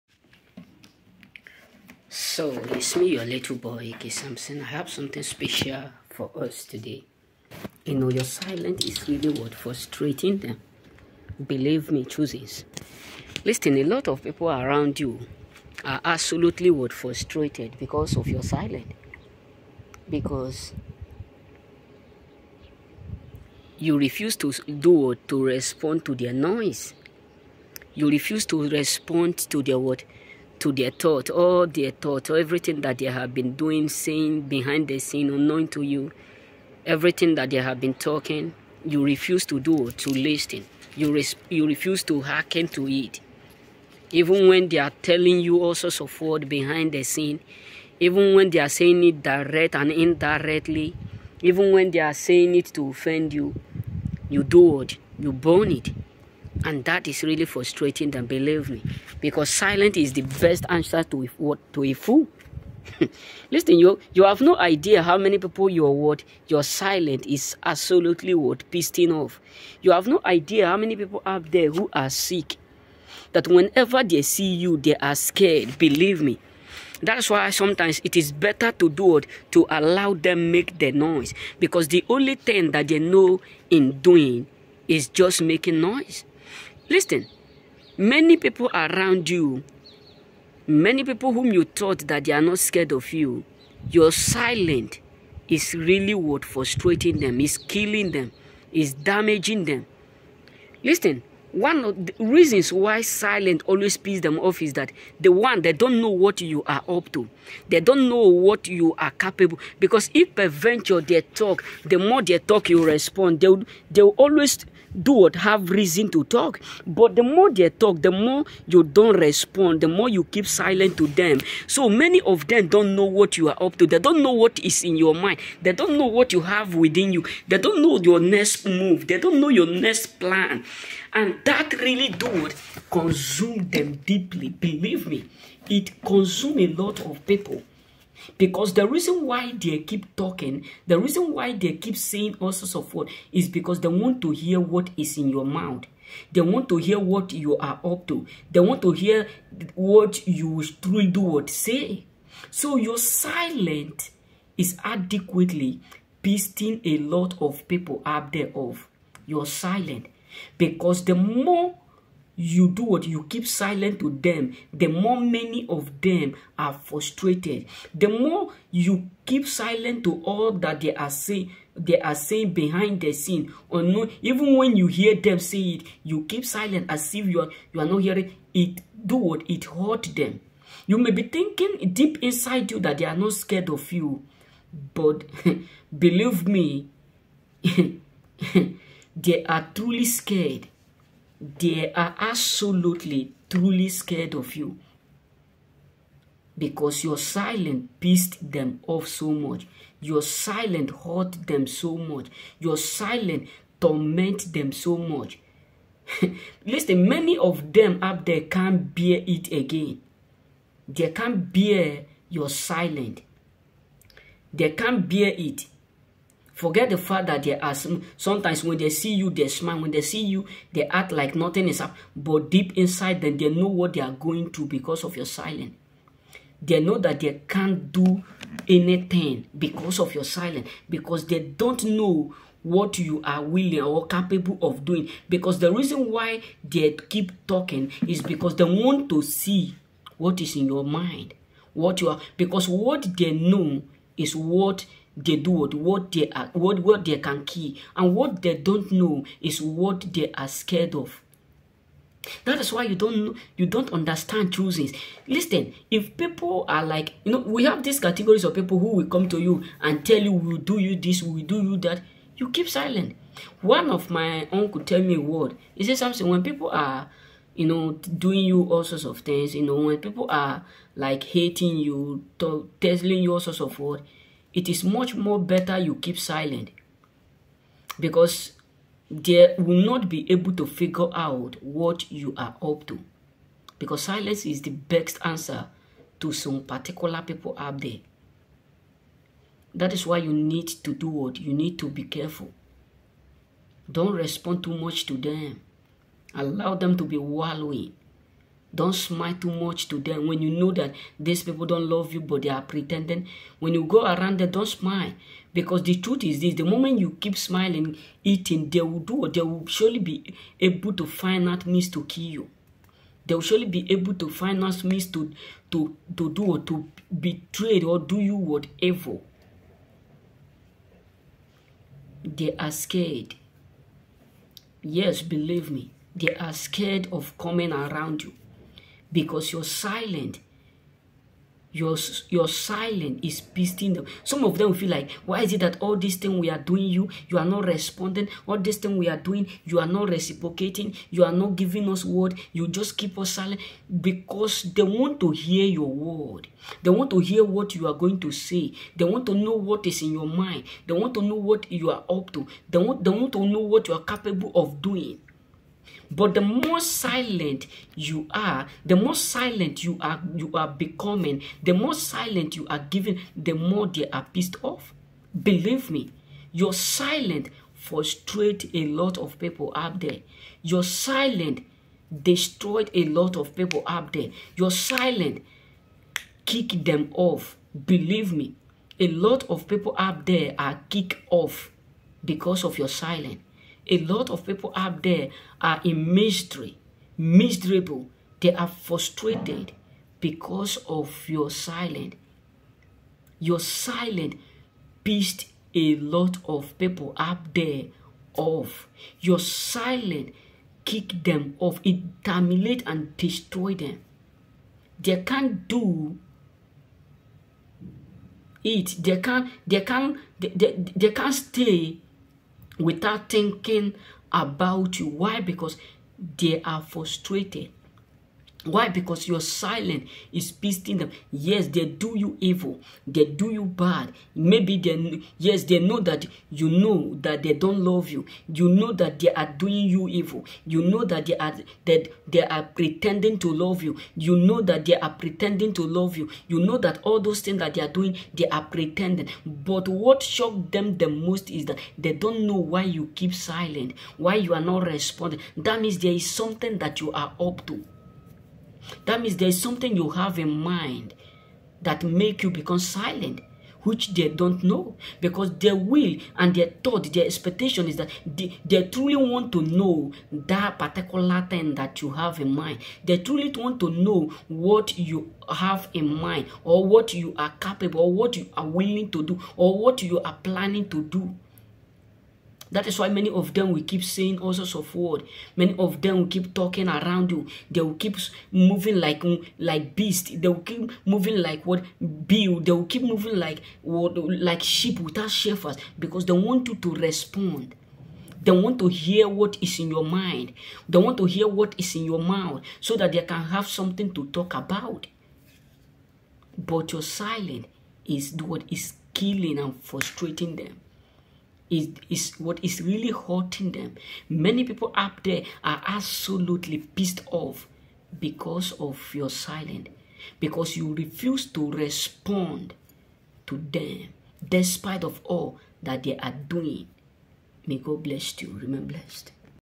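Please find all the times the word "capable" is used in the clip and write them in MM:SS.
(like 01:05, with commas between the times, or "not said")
01:49, 03:54, 05:54, 07:47.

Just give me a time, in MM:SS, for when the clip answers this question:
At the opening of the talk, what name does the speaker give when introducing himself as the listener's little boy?
00:03.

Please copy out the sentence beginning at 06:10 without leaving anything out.
Your silent destroyed a lot of people out there.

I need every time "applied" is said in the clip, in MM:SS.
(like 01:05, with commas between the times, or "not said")
not said.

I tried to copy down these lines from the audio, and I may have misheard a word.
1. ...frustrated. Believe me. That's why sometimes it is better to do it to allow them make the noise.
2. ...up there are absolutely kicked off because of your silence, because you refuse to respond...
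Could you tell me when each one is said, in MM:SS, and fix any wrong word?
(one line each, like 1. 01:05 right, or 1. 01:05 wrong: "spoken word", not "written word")
1. 01:15 wrong: "scared", not "frustrated"
2. 08:24 wrong: "pissed", not "kicked".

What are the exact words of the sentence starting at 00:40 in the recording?
You, res you refuse to hearken to it.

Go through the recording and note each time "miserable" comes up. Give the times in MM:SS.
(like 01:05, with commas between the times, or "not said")
06:27.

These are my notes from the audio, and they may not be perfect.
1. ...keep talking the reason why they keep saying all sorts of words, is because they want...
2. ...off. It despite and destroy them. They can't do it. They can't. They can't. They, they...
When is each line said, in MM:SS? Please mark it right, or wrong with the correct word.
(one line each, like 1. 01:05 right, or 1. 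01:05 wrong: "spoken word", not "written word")
1. 02:19 right
2. 06:41 wrong: "terminate", not "despite".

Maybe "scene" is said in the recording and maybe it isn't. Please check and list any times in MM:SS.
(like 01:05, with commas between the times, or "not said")
00:34, 00:47, 02:53.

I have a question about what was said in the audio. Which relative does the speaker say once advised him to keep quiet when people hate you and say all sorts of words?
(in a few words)
uncle.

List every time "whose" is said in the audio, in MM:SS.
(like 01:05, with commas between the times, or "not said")
not said.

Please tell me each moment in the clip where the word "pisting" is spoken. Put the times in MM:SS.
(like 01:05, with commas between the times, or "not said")
05:33, 07:00.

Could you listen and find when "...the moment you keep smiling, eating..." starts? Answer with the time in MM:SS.
05:06.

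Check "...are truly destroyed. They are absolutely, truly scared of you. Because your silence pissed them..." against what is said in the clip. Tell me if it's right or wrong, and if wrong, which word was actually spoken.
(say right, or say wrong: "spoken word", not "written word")
wrong: "scared", not "destroyed".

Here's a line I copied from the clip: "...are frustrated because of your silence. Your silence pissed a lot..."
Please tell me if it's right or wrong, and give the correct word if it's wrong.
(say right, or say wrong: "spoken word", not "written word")
right.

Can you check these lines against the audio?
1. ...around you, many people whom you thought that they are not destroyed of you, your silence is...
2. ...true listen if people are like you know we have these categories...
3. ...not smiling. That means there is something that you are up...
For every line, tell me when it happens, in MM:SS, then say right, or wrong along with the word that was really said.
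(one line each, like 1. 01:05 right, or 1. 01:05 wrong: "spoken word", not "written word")
1. 01:28 wrong: "scared", not "destroyed"
2. 04:14 right
3. 07:24 wrong: "responding", not "smiling".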